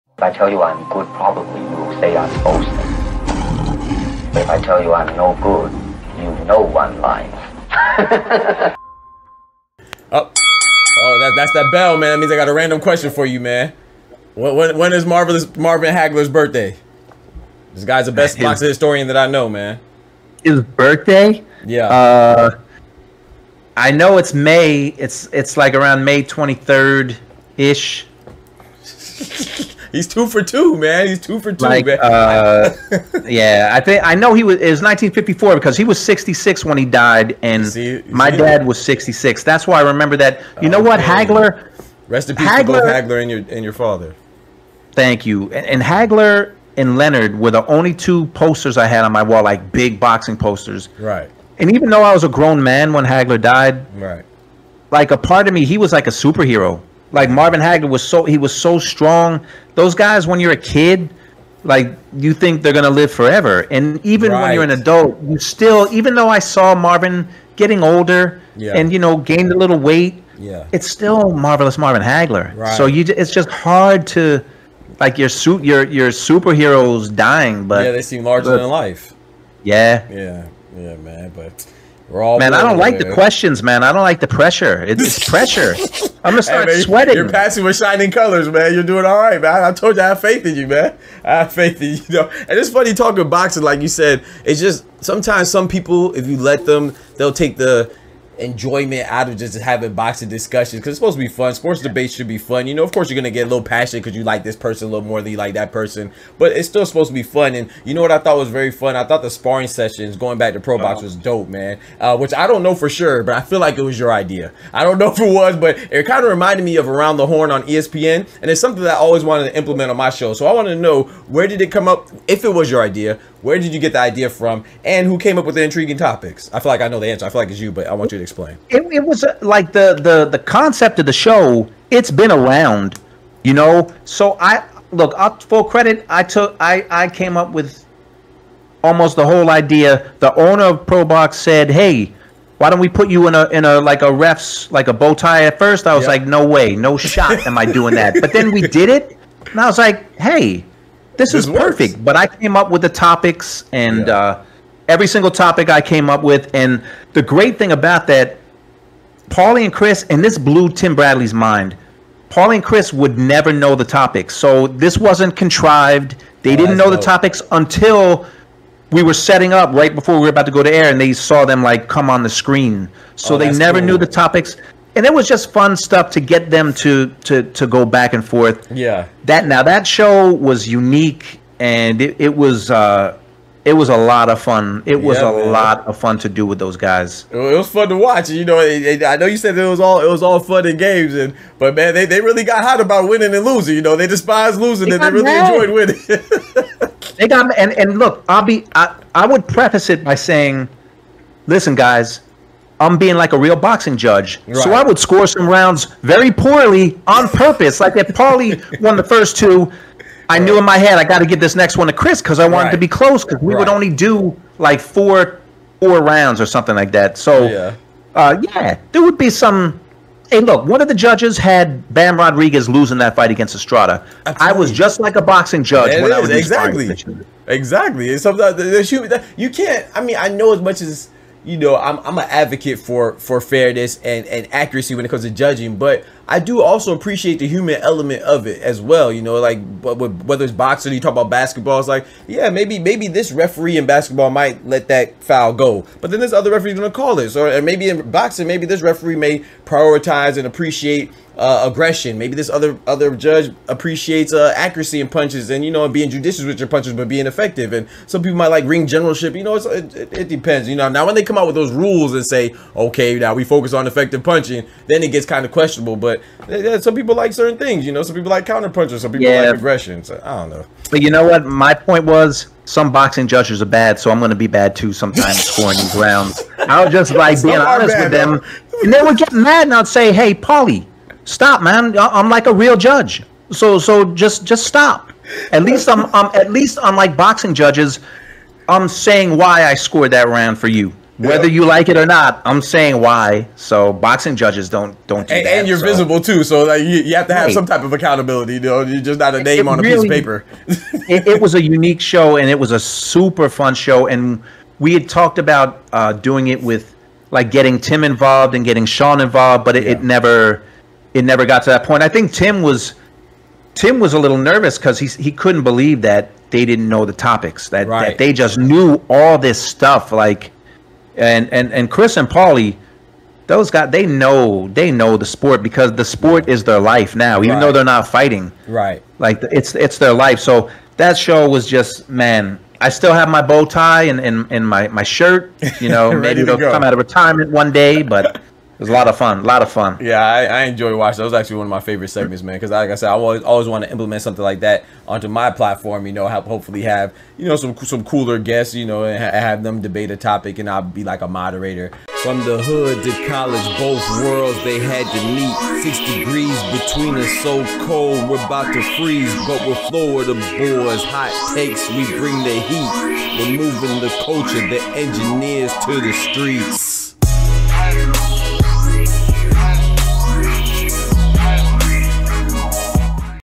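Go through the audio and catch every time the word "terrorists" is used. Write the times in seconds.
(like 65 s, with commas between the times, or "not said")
not said.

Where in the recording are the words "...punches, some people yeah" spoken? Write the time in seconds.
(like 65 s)
268 s.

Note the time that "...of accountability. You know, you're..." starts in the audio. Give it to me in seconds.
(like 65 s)
297 s.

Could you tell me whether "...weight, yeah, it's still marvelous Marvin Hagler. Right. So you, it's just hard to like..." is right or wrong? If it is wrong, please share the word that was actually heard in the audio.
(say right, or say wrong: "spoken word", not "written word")
right.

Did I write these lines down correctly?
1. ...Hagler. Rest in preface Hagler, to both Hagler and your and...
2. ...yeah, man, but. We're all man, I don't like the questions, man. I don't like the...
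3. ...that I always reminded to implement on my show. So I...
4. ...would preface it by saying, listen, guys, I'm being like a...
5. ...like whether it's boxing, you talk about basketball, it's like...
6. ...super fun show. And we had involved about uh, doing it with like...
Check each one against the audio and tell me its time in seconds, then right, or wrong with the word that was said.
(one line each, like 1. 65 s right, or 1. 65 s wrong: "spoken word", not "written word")
1. 40 s wrong: "peace", not "preface"
2. 80 s right
3. 118 s wrong: "wanted", not "reminded"
4. 199 s right
5. 239 s right
6. 302 s wrong: "talked", not "involved".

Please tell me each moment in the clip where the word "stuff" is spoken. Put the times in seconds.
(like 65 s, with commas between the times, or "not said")
175 s, 319 s.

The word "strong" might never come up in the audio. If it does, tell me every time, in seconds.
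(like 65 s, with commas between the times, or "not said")
58 s.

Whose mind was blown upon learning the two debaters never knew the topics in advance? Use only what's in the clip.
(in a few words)
Tim Bradley.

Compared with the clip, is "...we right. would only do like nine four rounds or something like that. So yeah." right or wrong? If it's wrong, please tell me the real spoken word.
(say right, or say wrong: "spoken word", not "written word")
wrong: "four", not "nine".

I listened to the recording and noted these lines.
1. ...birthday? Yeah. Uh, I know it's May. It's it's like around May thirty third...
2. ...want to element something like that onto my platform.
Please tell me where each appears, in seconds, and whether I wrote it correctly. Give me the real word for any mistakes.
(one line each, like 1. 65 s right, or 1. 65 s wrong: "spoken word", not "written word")
1. 20 s wrong: "twenty", not "thirty"
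2. 343 s wrong: "implement", not "element".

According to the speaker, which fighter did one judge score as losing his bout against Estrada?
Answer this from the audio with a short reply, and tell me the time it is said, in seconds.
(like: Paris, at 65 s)
Bam Rodriguez, at 221 s.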